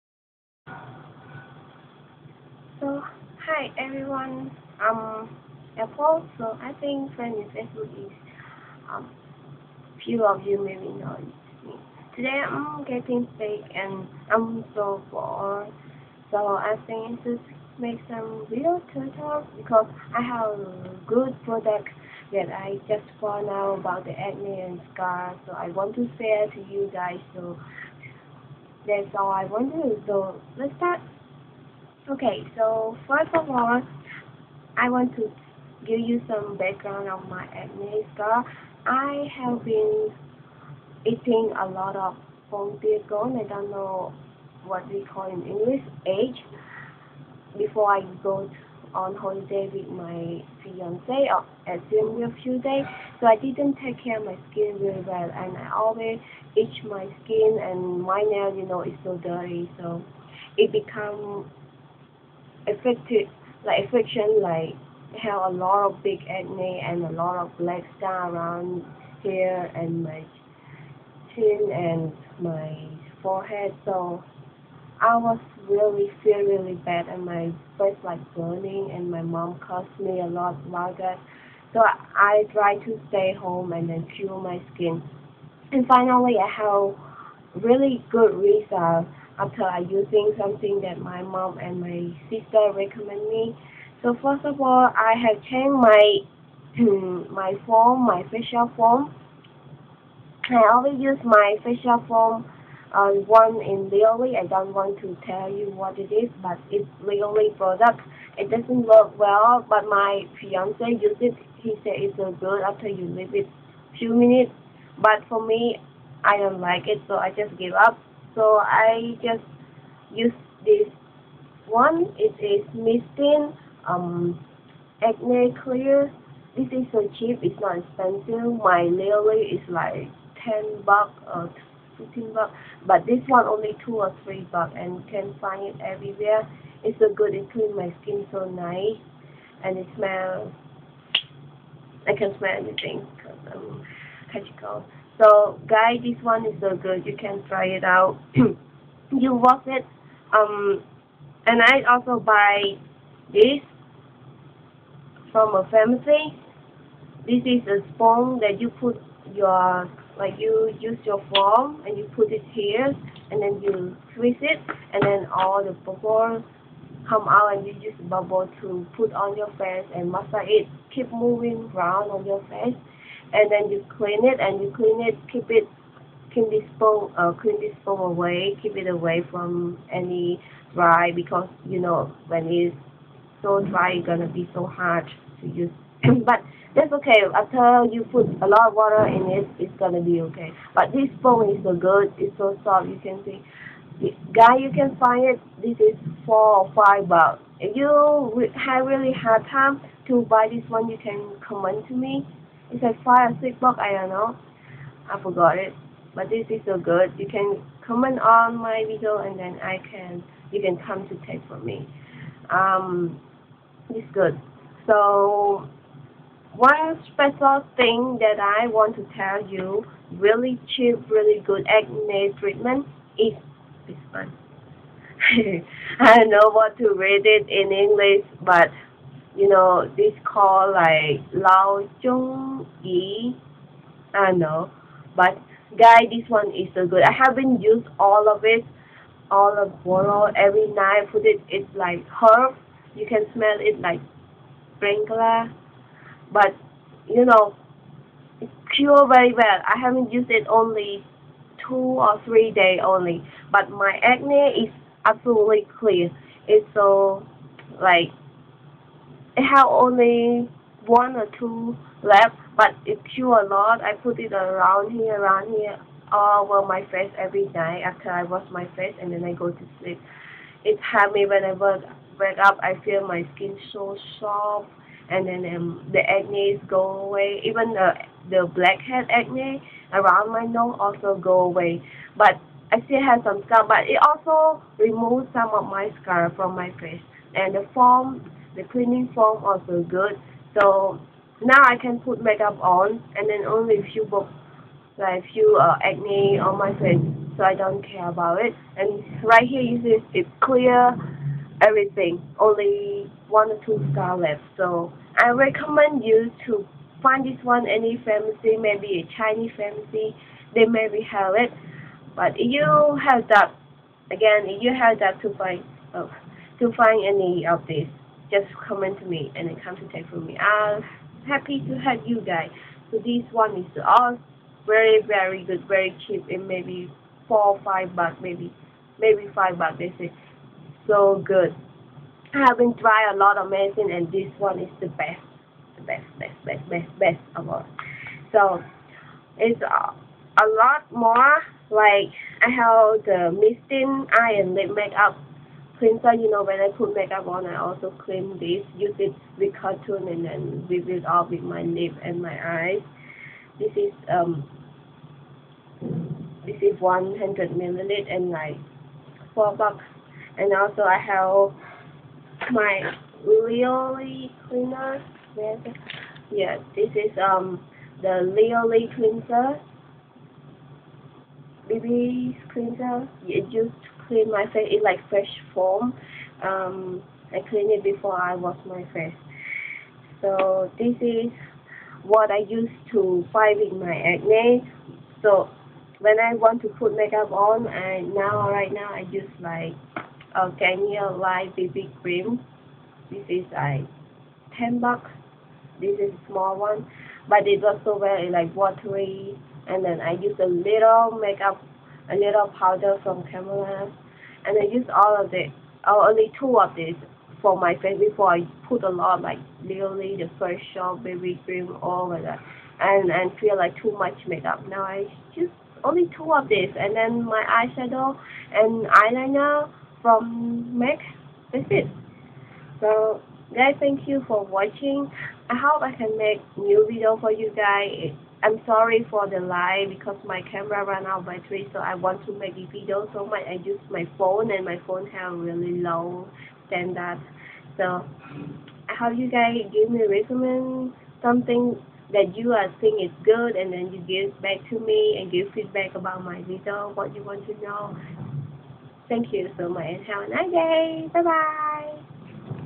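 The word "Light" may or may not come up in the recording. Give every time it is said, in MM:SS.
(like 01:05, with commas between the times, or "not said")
06:31.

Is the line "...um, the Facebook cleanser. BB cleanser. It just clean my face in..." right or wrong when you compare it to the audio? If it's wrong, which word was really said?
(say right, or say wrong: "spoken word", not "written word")
wrong: "Leoli", not "Facebook".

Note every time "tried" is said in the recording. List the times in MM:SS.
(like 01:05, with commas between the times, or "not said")
01:22, 05:32.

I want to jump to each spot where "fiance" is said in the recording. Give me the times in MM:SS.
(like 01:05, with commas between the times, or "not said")
00:50, 01:50.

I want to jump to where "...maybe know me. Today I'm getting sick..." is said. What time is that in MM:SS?
00:10.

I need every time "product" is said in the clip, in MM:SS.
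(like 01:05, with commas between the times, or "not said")
00:21, 01:47.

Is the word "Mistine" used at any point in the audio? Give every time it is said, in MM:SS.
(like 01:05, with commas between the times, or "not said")
02:02, 05:43.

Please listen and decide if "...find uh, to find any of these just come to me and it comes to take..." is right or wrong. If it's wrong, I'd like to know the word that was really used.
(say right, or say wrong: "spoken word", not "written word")
right.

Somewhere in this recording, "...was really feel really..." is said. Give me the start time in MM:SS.
01:15.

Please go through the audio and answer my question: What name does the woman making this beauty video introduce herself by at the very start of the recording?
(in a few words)
Apple.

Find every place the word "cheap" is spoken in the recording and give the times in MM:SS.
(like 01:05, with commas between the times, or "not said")
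02:07, 03:40, 05:26.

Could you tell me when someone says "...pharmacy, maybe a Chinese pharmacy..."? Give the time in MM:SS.
05:08.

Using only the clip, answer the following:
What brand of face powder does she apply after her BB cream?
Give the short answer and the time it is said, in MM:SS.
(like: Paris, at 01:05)
Camellia, at 06:43.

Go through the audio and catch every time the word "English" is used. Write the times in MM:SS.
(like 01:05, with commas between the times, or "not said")
00:45, 03:47.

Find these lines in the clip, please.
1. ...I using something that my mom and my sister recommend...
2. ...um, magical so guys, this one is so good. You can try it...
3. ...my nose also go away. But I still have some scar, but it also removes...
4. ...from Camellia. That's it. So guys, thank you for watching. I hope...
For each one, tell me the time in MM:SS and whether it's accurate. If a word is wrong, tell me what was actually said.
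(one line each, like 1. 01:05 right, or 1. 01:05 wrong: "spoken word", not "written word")
1. 01:29 right
2. 02:23 right
3. 04:40 right
4. 07:00 wrong: "MAC", not "Camellia".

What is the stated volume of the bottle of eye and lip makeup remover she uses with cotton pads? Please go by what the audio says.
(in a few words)
100 milliliters.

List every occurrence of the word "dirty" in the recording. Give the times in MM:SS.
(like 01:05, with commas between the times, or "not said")
00:59.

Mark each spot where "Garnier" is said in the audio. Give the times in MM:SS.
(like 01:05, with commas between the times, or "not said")
06:30.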